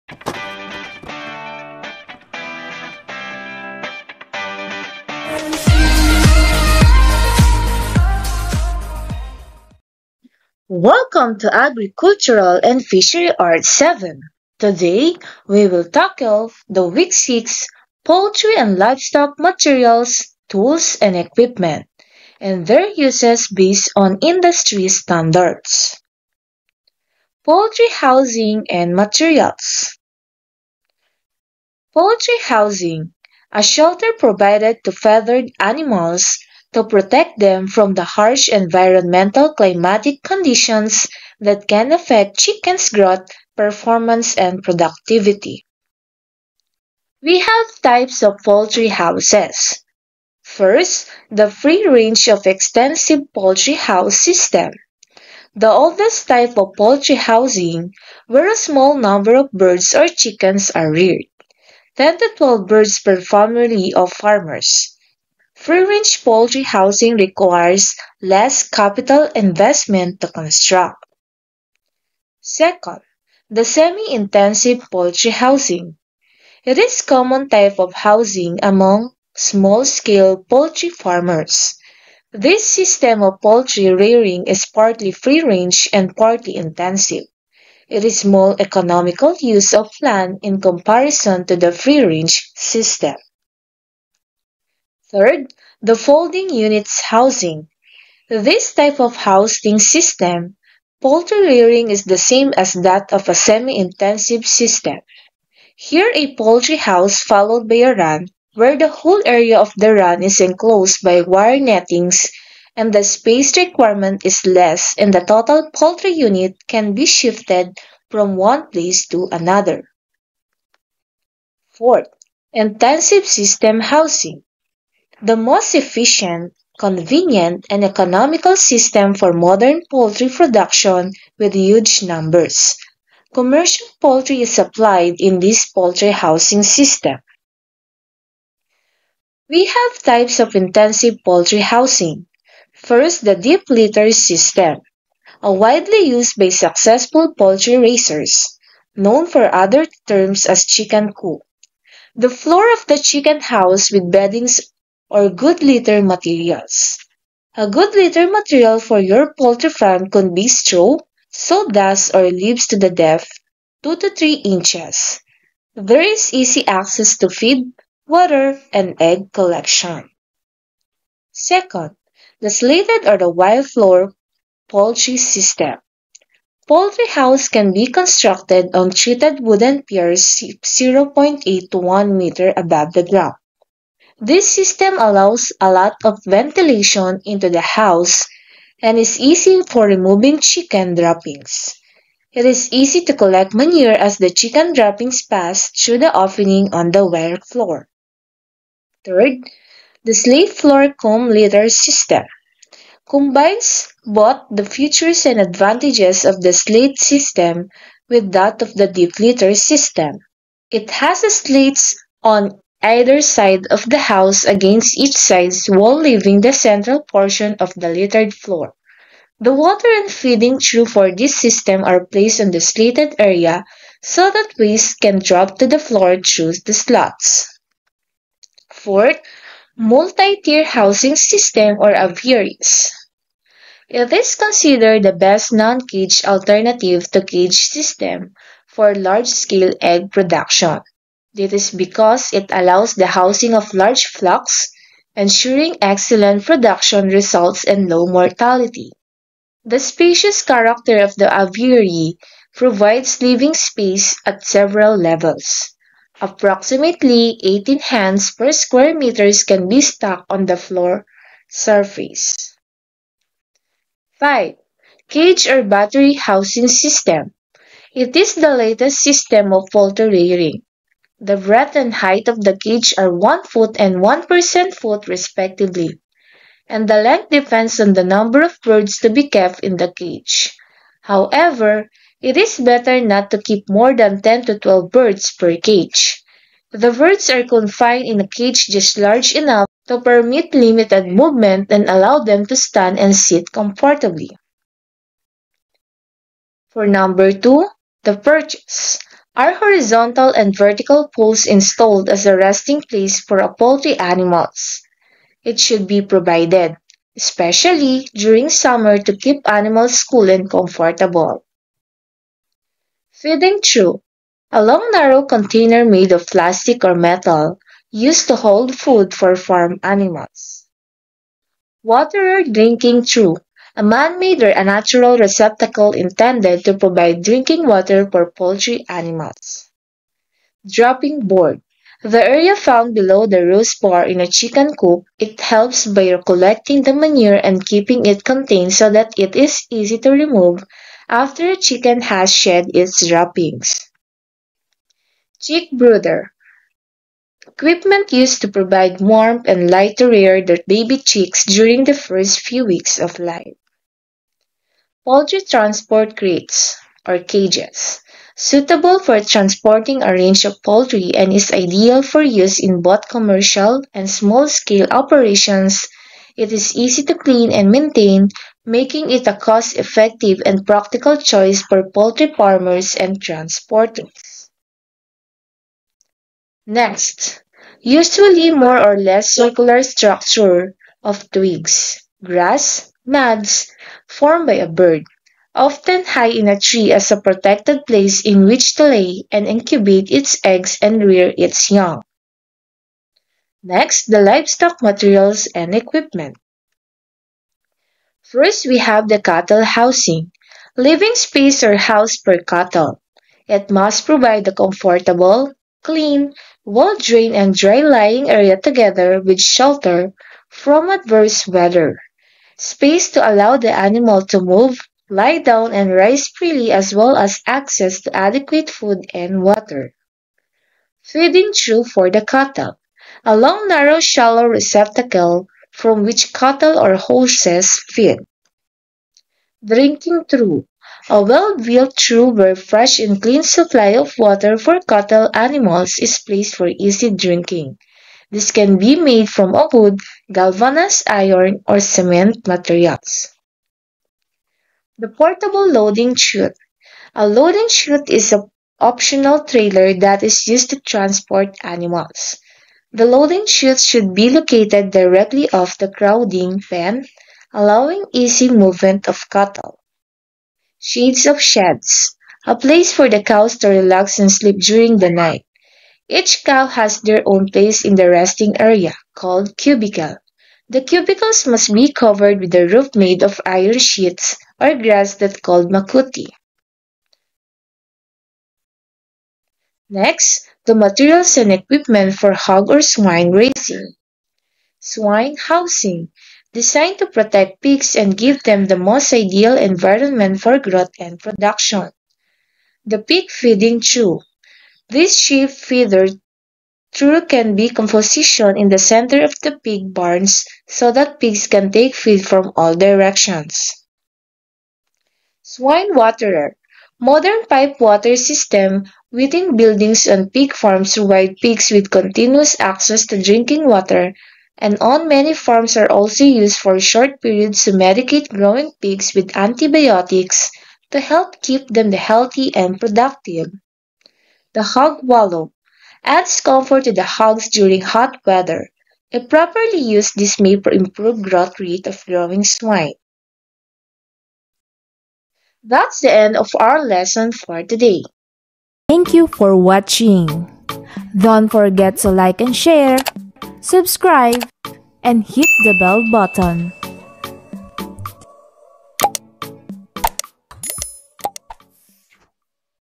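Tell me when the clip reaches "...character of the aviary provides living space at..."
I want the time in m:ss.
4:10.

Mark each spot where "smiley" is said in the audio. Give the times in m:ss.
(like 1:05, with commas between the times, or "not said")
not said.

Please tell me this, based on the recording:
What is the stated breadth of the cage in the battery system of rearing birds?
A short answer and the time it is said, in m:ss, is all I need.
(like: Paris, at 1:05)
1 foot, at 4:33.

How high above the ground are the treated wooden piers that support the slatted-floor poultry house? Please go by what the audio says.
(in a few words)
0.8 to 1 meter.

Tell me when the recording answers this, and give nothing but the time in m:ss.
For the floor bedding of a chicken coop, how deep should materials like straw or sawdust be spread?
2:43.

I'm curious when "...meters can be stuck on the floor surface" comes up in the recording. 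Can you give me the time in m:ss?
4:18.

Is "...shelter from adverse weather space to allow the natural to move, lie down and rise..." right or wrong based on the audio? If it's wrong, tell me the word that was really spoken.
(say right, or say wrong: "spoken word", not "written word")
wrong: "animal", not "natural".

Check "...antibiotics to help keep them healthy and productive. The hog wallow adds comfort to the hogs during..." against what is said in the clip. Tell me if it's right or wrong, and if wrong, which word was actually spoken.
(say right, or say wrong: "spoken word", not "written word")
right.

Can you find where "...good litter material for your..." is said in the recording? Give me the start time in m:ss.
2:37.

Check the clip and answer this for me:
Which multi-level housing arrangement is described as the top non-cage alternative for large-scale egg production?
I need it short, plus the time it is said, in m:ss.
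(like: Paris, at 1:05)
Aviaries, at 3:51.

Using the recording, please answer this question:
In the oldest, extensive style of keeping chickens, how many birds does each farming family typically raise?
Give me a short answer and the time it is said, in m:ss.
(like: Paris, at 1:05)
10 to 12, at 1:01.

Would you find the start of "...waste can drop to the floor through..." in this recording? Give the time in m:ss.
3:44.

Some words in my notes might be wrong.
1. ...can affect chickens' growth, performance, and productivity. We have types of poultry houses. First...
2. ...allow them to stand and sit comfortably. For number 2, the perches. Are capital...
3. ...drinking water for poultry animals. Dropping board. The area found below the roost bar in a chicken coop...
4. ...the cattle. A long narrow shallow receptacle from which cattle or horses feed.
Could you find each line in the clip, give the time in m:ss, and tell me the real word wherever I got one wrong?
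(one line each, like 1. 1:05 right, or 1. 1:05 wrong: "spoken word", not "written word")
1. 0:41 right
2. 4:51 wrong: "horizontal", not "capital"
3. 5:27 right
4. 7:02 right.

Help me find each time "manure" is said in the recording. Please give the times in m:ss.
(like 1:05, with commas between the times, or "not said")
3:13, 5:36.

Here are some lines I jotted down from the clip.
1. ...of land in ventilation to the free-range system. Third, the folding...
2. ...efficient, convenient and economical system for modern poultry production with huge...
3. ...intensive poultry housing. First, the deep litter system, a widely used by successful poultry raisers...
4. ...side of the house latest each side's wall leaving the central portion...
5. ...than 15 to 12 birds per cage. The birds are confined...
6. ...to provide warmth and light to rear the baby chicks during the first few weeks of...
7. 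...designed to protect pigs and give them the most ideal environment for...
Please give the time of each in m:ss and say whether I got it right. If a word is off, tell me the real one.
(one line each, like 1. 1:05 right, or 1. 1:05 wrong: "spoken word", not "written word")
1. 1:29 wrong: "comparison", not "ventilation"
2. 2:05 right
3. 2:20 right
4. 3:33 wrong: "against", not "latest"
5. 4:43 wrong: "10", not "15"
6. 5:48 right
7. 8:06 right.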